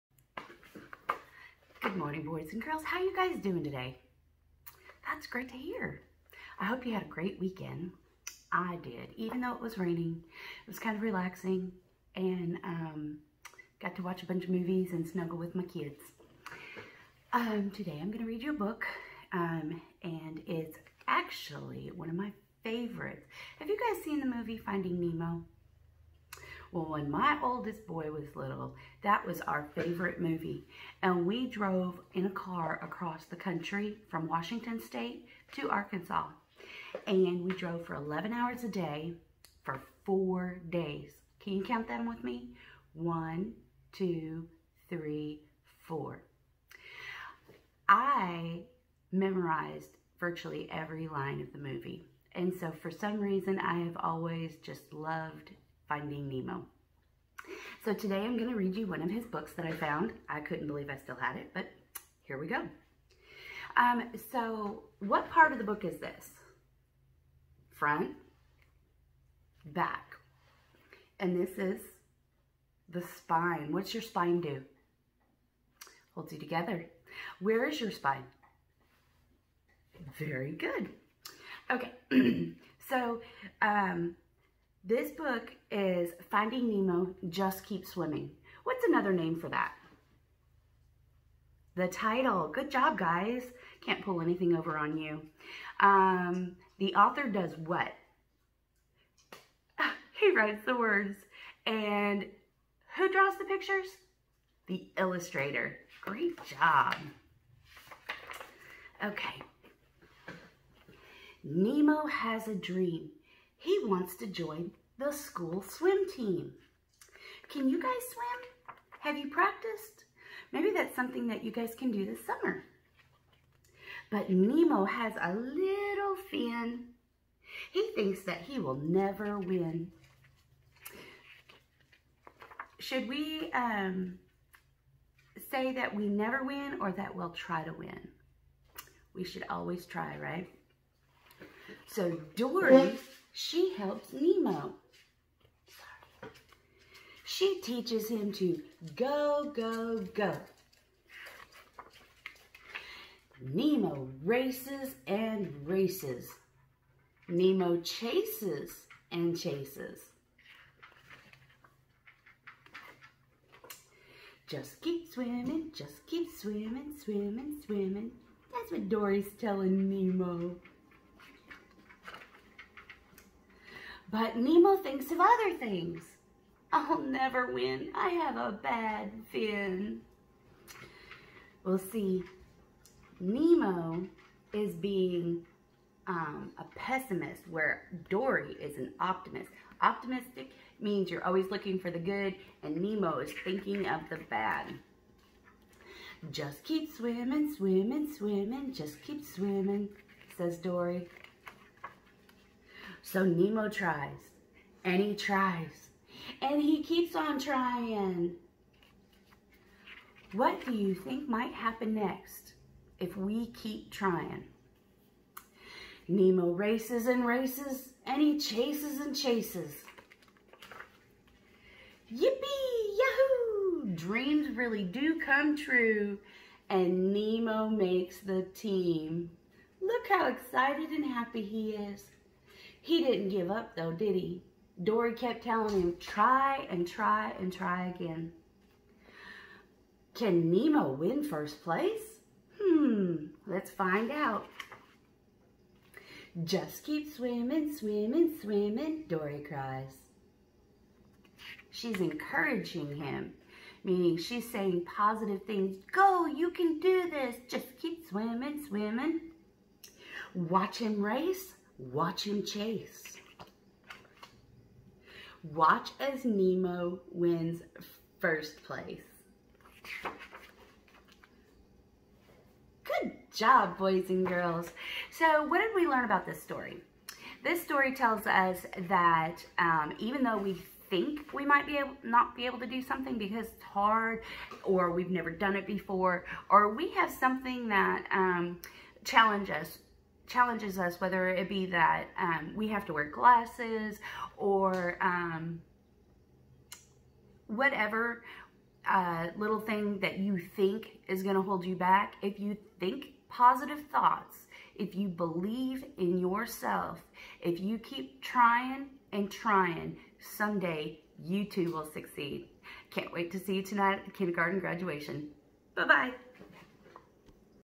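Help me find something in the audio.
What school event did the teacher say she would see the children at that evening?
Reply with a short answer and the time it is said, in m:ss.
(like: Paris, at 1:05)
kindergarten graduation, at 5:14.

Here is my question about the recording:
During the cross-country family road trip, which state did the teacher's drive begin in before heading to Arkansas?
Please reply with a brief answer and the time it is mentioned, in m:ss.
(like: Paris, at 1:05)
Washington State, at 0:34.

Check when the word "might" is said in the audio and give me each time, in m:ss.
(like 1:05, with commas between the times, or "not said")
3:31, 4:41.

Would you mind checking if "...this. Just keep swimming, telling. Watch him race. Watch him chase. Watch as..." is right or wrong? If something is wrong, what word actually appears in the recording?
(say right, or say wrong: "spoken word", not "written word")
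wrong: "swimming", not "telling".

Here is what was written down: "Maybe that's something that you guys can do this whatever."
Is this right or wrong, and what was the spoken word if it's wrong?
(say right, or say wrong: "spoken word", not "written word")
wrong: "summer", not "whatever".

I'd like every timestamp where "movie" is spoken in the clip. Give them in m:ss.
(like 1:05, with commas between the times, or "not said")
0:14, 0:24, 0:30, 0:51.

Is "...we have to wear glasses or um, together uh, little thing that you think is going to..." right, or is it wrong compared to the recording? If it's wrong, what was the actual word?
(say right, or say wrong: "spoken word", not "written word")
wrong: "whatever", not "together".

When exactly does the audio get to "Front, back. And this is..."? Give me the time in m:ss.
1:07.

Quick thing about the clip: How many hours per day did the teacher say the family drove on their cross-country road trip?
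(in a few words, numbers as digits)
11.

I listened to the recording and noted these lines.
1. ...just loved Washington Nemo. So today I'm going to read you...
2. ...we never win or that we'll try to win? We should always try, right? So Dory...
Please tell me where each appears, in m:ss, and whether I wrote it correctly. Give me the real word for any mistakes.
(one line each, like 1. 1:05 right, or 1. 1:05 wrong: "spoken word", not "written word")
1. 0:54 wrong: "Finding", not "Washington"
2. 2:15 right.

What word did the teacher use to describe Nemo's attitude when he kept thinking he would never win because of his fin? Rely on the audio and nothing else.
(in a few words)
pessimist.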